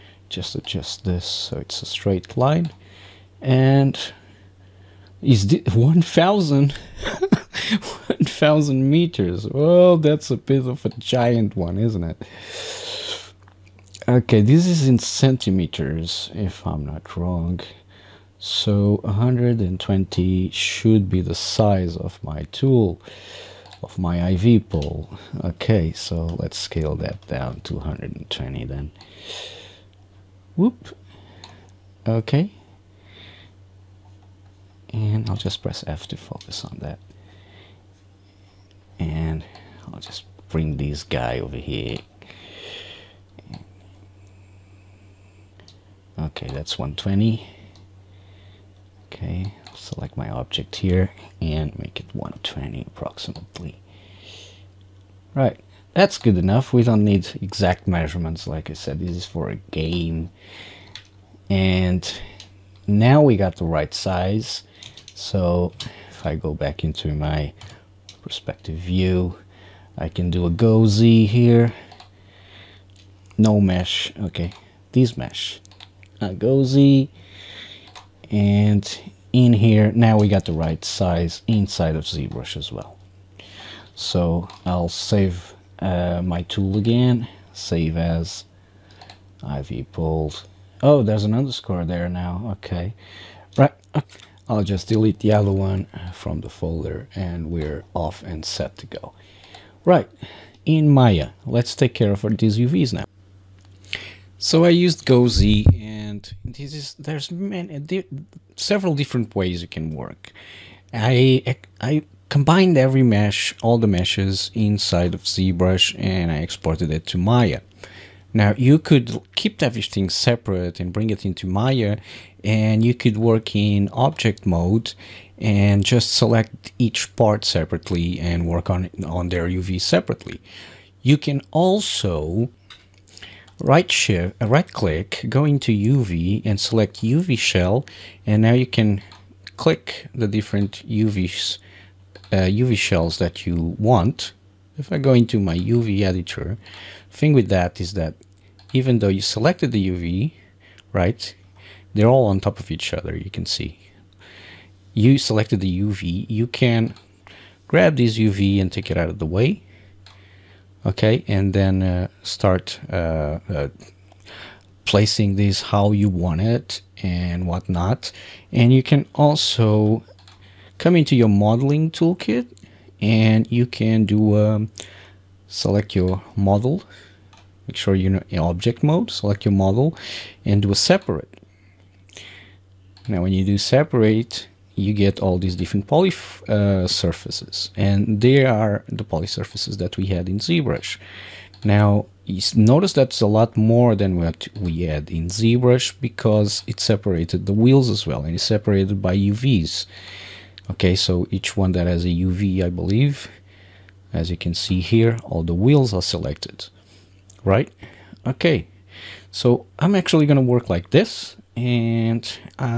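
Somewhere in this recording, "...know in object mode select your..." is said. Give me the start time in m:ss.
2:58.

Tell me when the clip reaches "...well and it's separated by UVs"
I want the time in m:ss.
3:18.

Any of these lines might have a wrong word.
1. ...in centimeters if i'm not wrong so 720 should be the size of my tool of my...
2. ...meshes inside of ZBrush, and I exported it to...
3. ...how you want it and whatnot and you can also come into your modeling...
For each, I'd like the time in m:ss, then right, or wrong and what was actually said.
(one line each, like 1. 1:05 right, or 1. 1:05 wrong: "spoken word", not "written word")
1. 0:14 wrong: "120", not "720"
2. 1:53 right
3. 2:45 right.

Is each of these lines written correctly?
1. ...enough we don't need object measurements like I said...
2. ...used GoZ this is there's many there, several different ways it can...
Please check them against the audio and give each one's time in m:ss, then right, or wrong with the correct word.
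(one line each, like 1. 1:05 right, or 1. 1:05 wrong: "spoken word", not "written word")
1. 0:56 wrong: "exact", not "object"
2. 1:44 right.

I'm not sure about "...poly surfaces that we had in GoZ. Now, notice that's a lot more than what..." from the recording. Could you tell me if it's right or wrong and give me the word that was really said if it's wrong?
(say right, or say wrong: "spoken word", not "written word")
wrong: "ZBrush", not "GoZ".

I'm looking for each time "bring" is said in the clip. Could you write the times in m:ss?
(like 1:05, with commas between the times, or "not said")
0:40, 2:00.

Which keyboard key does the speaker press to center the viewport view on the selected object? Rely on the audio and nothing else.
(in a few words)
F.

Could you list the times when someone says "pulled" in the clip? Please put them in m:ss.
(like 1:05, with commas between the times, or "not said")
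1:29.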